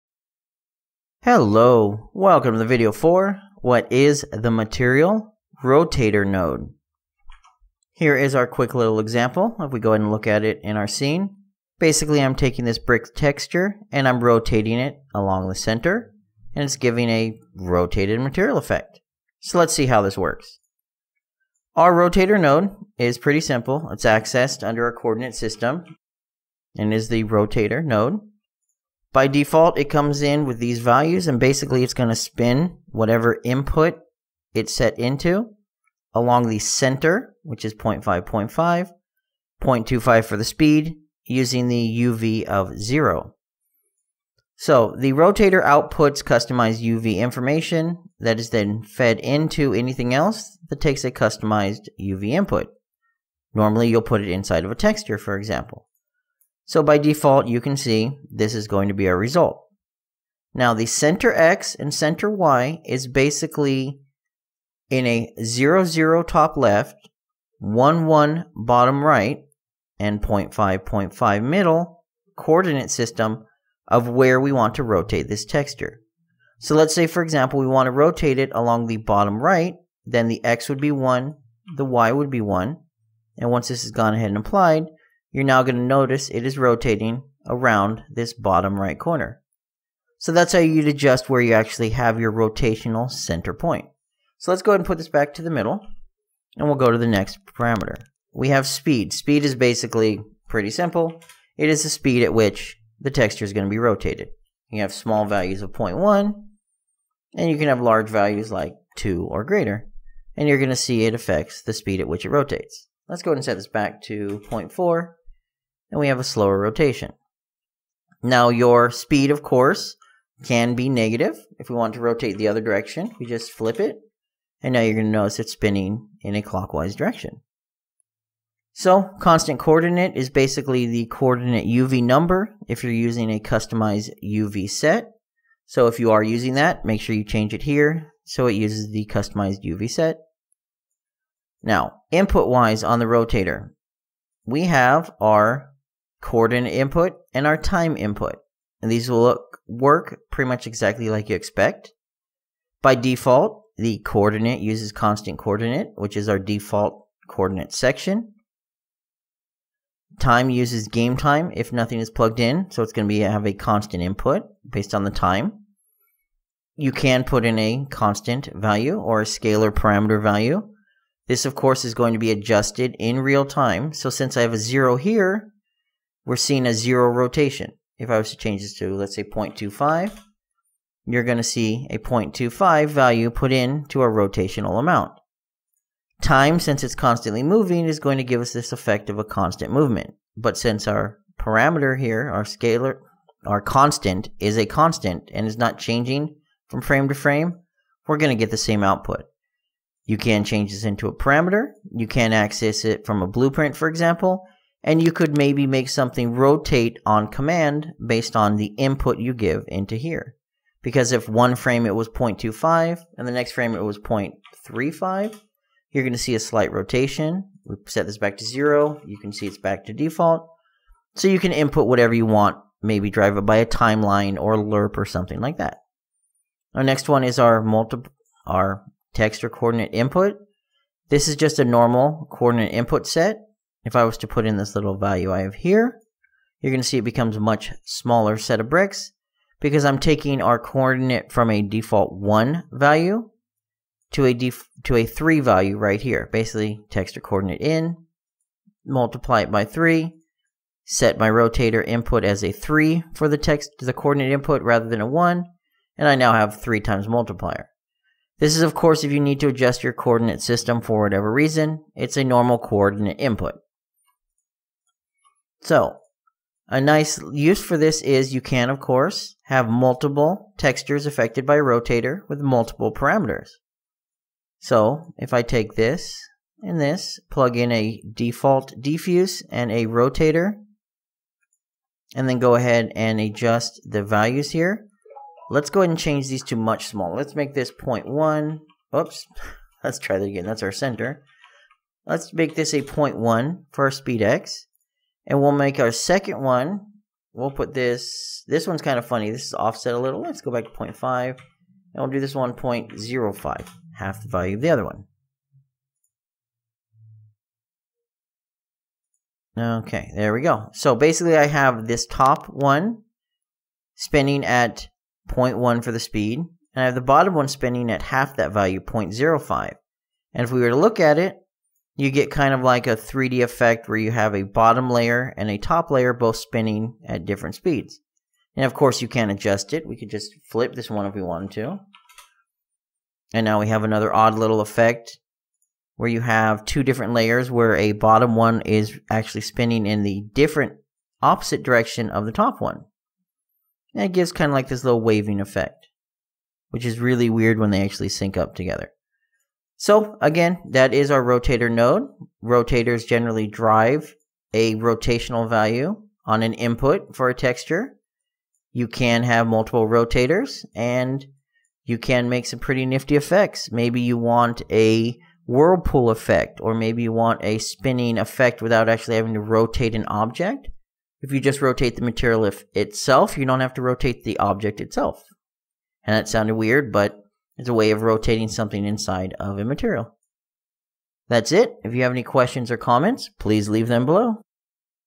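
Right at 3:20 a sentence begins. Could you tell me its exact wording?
You can change this into a parameter.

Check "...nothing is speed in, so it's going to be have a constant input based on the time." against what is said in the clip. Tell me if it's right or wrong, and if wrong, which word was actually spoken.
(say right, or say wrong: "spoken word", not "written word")
wrong: "plugged", not "speed".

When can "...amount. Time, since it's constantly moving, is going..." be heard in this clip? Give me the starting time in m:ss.
3:04.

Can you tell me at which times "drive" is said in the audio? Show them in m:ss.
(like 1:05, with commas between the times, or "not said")
3:43, 5:53.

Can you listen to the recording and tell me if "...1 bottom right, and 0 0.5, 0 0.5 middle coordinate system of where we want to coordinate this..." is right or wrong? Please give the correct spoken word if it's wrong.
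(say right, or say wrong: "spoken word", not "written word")
wrong: "rotate", not "coordinate".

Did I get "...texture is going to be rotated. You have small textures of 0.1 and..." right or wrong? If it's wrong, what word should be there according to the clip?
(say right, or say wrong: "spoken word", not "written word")
wrong: "values", not "textures".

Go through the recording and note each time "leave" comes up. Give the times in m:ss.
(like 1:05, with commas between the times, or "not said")
6:23.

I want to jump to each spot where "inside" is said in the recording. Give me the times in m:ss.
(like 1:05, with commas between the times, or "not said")
0:54, 6:18.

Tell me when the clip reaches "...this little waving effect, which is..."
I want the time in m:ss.
5:44.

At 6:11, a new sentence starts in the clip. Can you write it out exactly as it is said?
If you just rotate the material itself, you don't have to rotate the object itself.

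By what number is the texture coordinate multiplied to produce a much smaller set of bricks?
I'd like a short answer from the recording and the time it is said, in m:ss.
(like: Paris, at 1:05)
3, at 4:08.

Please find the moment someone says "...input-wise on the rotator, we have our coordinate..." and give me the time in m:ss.
2:22.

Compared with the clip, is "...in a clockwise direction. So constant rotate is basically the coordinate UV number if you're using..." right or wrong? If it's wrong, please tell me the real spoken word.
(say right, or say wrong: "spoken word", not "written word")
wrong: "coordinate", not "rotate".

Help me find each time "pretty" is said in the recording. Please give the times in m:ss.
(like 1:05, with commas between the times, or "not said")
0:23, 1:40, 2:30, 6:02.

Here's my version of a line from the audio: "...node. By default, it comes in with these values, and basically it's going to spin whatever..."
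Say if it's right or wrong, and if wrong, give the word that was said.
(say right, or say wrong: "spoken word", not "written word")
right.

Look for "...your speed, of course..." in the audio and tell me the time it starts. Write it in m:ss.
1:58.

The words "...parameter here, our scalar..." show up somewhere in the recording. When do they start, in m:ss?
3:11.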